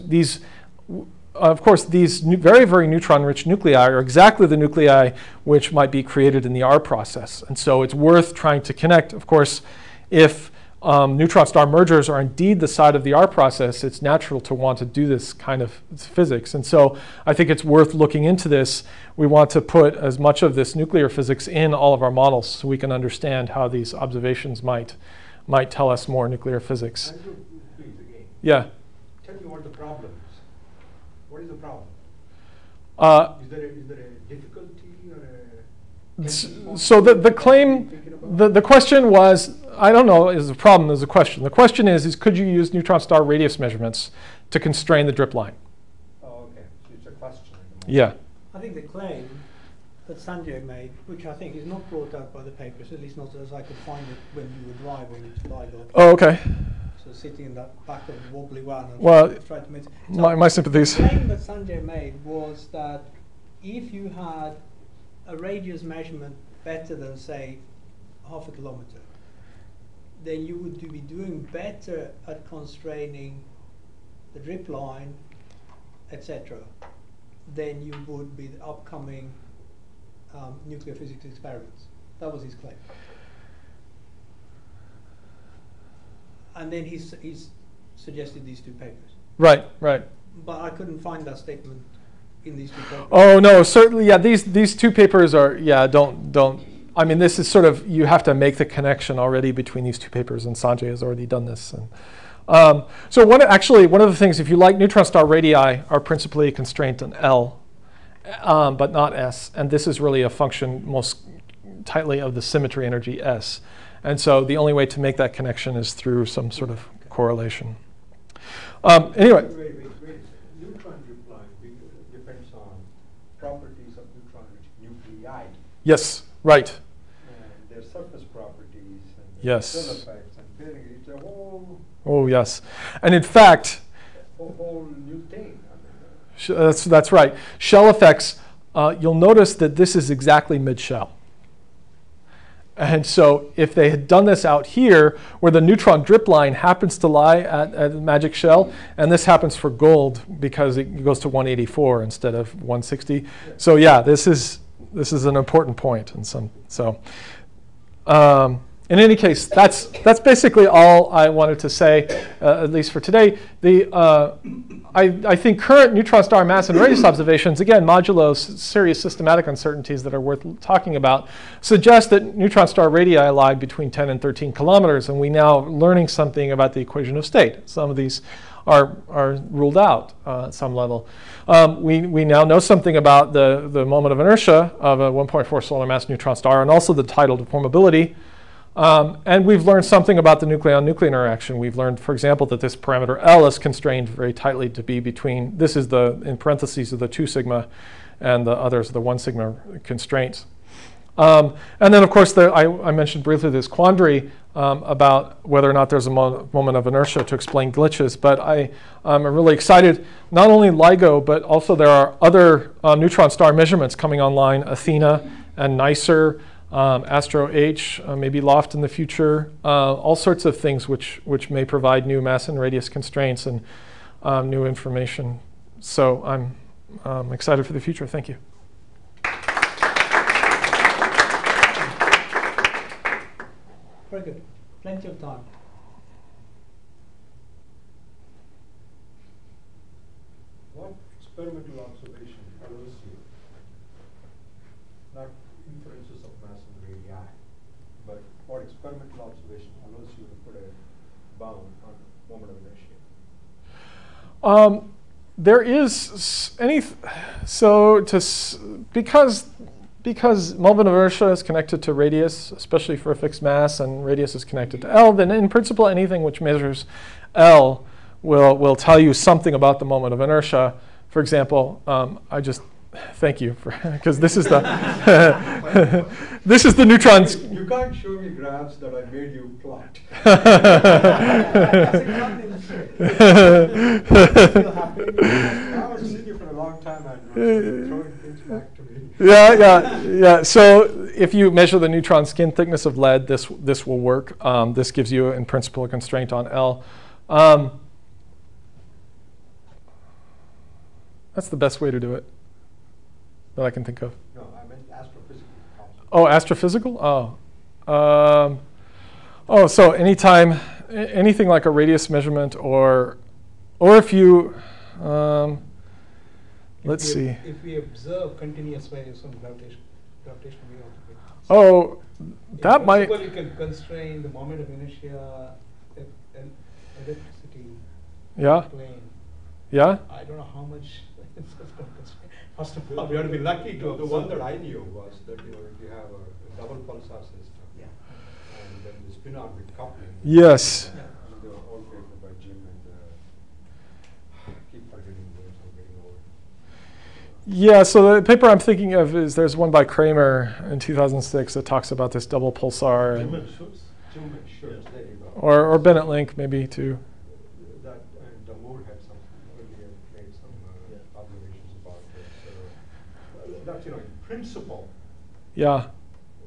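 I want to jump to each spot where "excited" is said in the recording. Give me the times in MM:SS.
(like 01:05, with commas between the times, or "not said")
03:29, 03:47.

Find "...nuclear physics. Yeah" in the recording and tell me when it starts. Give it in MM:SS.
00:26.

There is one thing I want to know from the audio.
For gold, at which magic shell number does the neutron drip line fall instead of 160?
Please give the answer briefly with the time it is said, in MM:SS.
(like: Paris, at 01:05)
184, at 02:31.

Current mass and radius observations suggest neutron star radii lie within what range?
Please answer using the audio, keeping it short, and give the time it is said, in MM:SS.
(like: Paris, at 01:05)
10 to 13 kilometers, at 02:53.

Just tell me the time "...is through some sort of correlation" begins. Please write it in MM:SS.
01:55.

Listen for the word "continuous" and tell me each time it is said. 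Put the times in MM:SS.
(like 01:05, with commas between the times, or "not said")
05:18.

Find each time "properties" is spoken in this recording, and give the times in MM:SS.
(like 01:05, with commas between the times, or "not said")
02:03, 02:08.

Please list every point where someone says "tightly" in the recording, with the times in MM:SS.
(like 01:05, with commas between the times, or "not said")
01:51, 03:14.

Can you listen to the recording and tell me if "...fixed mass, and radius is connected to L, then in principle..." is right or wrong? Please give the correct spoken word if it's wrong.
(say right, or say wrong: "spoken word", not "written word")
right.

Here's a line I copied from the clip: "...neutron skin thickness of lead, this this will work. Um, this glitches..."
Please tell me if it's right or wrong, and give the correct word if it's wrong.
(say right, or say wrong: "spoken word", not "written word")
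wrong: "gives", not "glitches".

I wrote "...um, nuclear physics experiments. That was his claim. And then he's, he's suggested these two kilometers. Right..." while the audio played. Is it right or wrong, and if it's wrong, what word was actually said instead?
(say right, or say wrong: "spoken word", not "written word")
wrong: "papers", not "kilometers".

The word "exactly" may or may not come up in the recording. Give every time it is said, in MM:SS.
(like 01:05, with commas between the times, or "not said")
00:03, 02:20, 04:47.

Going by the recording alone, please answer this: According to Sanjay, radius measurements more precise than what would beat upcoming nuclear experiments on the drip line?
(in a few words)
half a kilometer.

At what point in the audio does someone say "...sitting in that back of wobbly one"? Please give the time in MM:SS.
00:57.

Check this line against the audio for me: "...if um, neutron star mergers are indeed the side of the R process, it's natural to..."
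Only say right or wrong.
right.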